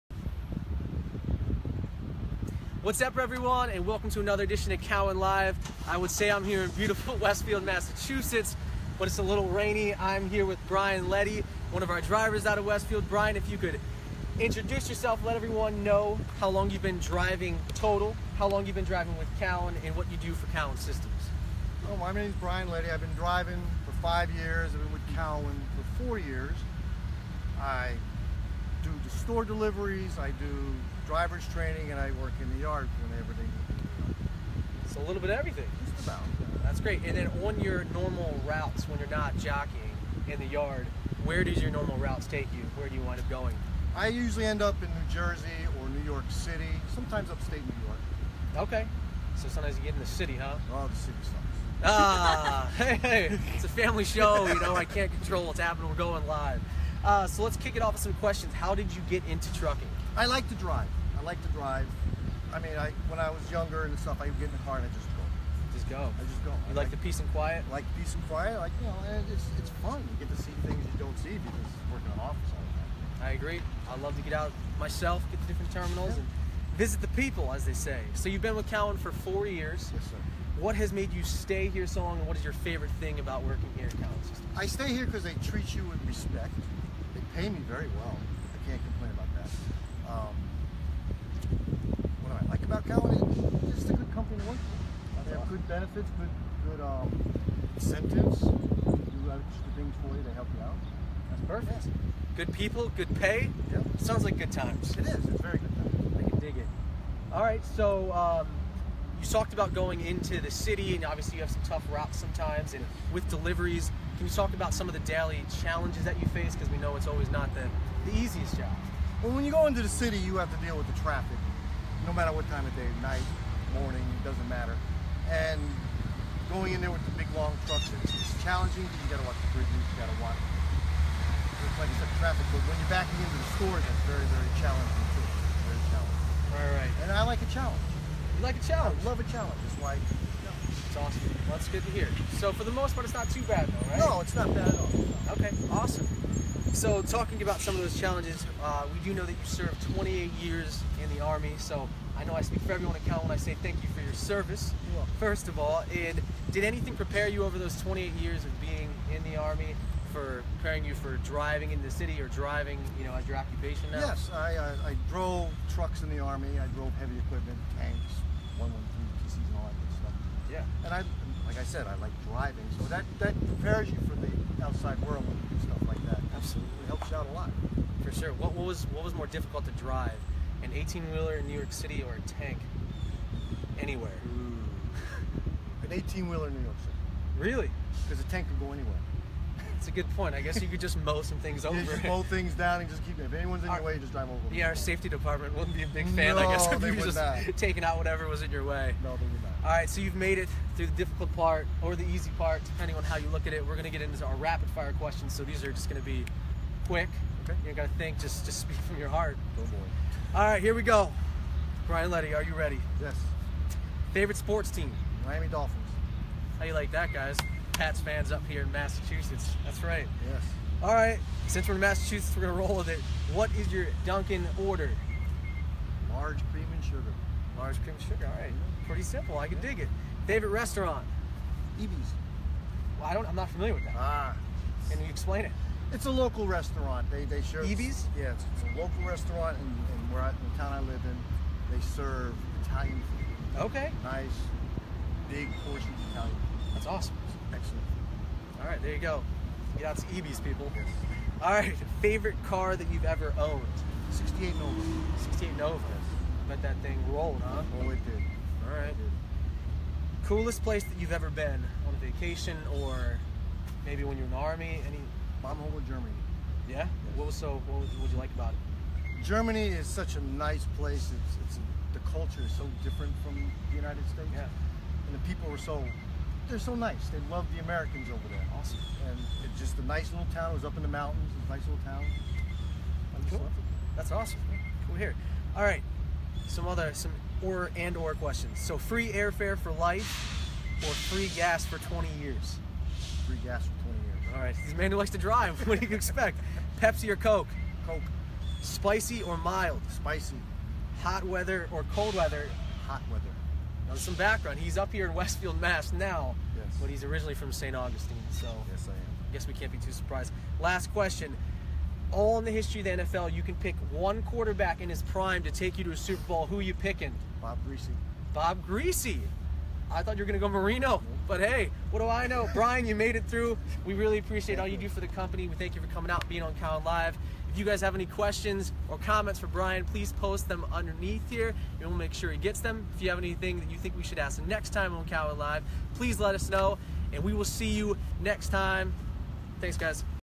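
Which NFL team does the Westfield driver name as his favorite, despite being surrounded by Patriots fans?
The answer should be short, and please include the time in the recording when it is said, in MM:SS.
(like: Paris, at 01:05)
Miami Dolphins, at 03:35.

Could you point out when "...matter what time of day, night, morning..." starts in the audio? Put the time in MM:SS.
02:02.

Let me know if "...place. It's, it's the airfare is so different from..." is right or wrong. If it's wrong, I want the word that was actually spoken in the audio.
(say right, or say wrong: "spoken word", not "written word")
wrong: "culture", not "airfare".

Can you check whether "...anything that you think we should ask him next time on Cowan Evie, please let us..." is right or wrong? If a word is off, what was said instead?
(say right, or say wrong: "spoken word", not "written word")
wrong: "Live", not "Evie".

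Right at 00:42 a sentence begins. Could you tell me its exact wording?
Where do you wind up going?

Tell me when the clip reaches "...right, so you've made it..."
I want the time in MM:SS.
03:19.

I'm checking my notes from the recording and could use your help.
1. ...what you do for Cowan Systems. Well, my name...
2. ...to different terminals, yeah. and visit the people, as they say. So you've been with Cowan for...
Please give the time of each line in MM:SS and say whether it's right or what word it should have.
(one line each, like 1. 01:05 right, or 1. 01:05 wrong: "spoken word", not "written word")
1. 00:19 right
2. 01:15 right.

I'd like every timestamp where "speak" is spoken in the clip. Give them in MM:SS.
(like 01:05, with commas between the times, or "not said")
02:32, 03:28.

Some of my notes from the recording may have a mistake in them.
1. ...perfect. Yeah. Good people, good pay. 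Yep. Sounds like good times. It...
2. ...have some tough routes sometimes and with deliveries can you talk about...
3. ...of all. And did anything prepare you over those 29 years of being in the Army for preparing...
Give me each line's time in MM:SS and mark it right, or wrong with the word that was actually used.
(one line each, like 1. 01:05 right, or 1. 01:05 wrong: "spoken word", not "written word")
1. 01:41 right
2. 01:51 right
3. 02:35 wrong: "28", not "29".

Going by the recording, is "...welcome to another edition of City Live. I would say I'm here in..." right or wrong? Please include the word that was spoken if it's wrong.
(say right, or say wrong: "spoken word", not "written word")
wrong: "Cowan", not "City".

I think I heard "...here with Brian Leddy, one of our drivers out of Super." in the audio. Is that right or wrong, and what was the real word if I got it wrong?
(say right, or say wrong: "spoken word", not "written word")
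wrong: "Westfield", not "Super".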